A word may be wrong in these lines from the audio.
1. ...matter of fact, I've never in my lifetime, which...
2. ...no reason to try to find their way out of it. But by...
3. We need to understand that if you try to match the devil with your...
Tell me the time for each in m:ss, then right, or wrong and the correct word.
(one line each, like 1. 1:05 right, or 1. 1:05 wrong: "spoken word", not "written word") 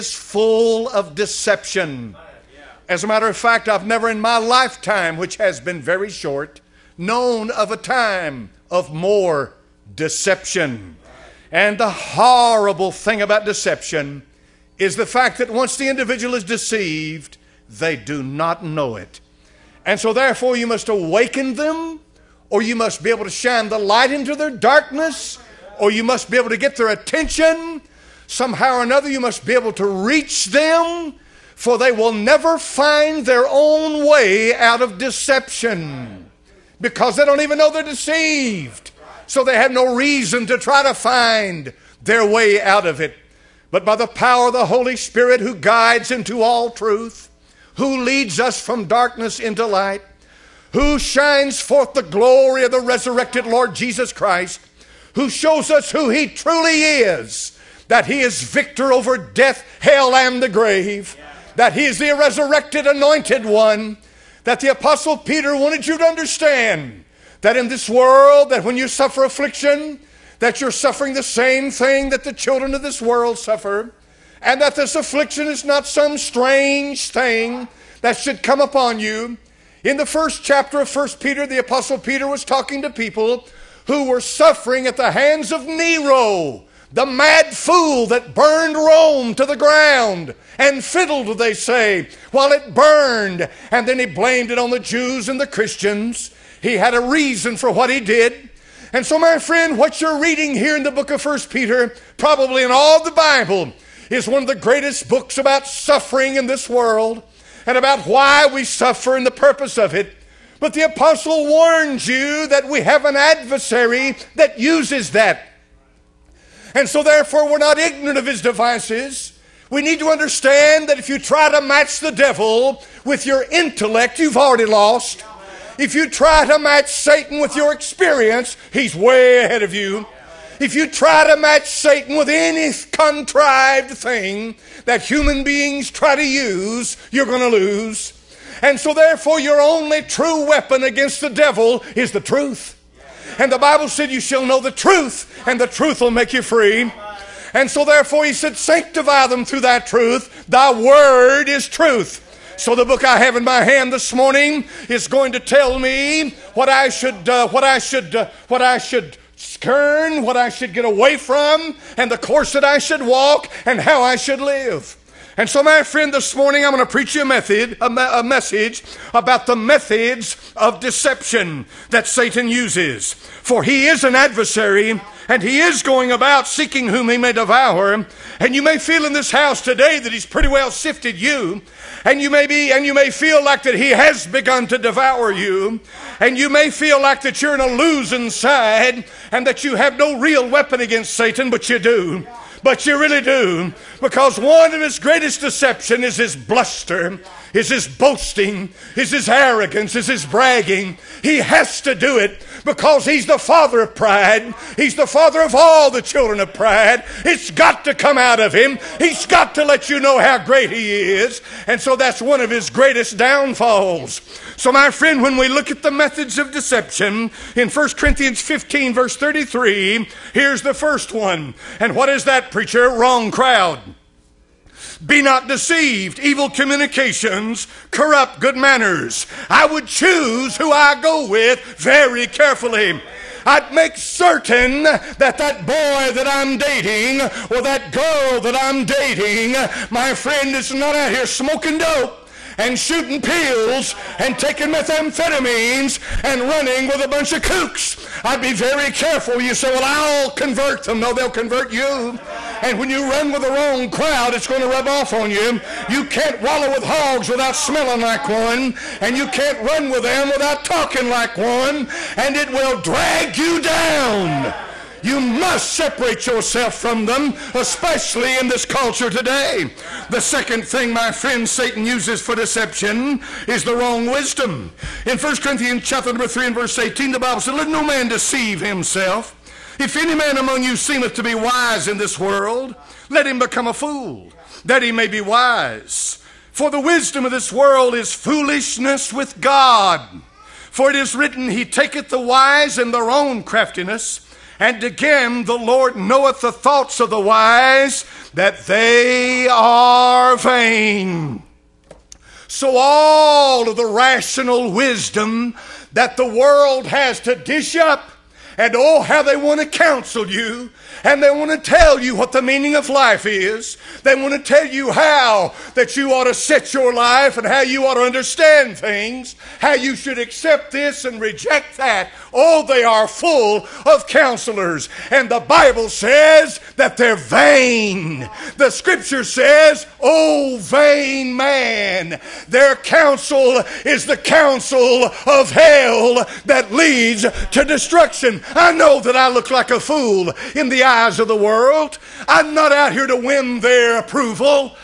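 1. 0:03 right
2. 0:39 right
3. 1:59 right.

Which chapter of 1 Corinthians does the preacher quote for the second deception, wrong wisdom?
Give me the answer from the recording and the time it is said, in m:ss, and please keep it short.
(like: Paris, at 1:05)
Chapter 3, at 4:35.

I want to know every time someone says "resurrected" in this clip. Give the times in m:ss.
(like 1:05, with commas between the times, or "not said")
0:52, 1:02.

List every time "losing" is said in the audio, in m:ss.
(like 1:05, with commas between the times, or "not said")
3:07.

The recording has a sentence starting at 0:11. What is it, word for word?
And the horrible thing about deception is the fact that once the individual is deceived, they do not know it.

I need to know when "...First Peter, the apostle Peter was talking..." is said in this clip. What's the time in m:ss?
1:20.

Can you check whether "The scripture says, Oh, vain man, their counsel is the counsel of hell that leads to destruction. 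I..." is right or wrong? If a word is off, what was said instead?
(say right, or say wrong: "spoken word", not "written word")
right.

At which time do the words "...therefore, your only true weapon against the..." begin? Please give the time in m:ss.
2:18.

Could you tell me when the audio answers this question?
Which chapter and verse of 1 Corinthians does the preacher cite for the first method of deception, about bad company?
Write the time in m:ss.
3:37.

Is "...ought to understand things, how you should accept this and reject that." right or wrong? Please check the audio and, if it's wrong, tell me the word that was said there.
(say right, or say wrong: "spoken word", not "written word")
right.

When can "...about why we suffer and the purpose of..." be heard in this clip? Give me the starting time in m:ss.
1:47.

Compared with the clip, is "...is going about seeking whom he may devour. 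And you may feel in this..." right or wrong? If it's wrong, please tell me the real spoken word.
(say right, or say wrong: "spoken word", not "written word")
right.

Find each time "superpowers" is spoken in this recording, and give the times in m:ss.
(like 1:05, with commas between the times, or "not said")
not said.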